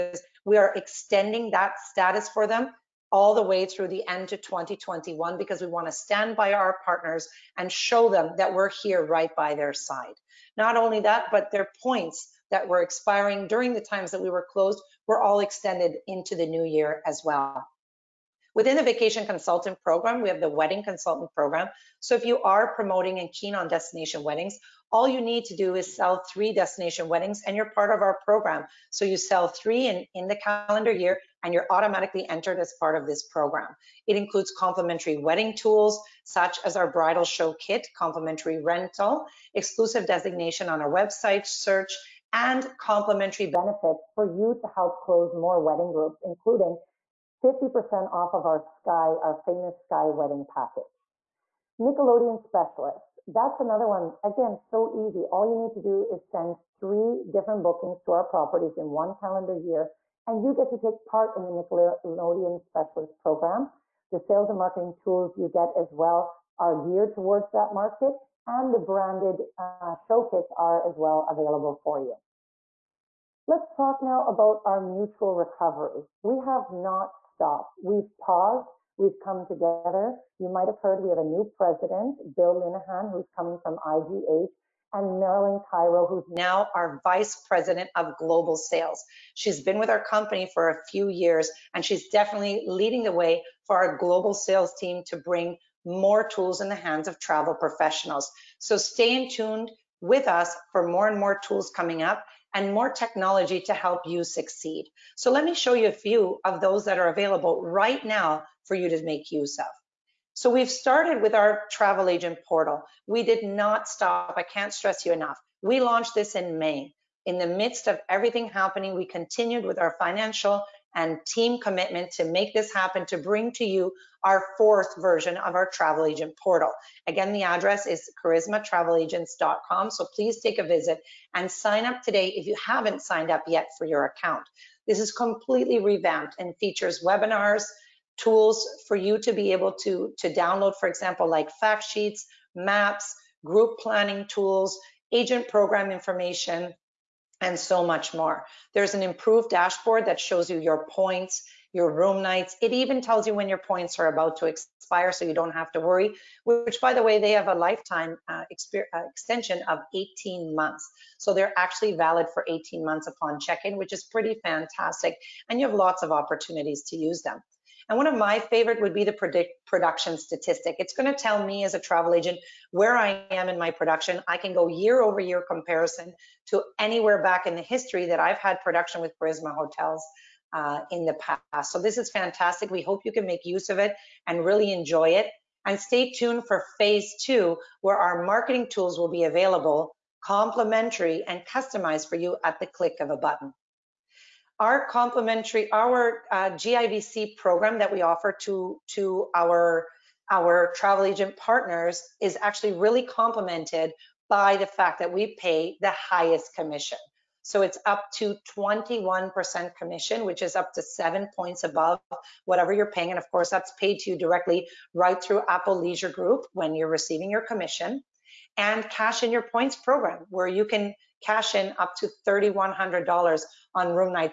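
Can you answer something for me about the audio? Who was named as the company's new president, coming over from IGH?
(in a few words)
Bill Linehan.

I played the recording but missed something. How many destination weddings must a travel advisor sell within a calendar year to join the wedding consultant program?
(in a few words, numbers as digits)
3.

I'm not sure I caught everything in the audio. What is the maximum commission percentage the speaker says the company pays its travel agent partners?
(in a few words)
21%.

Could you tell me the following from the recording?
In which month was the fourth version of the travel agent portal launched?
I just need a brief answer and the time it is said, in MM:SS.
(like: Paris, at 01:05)
May, at 01:56.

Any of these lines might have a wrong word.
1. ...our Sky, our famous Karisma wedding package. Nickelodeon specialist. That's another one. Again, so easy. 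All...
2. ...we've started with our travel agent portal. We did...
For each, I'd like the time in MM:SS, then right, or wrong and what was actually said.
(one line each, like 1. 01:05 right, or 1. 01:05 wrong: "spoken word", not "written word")
1. 00:48 wrong: "Sky", not "Karisma"
2. 01:50 right.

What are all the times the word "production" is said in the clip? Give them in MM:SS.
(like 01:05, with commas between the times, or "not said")
02:49, 02:53, 02:58.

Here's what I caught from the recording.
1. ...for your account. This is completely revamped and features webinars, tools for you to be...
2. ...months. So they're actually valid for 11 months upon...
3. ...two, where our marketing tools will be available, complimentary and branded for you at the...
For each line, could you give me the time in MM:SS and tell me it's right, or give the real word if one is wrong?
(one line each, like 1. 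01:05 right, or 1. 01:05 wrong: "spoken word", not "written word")
1. 02:13 right
2. 02:40 wrong: "18", not "11"
3. 03:07 wrong: "customized", not "branded".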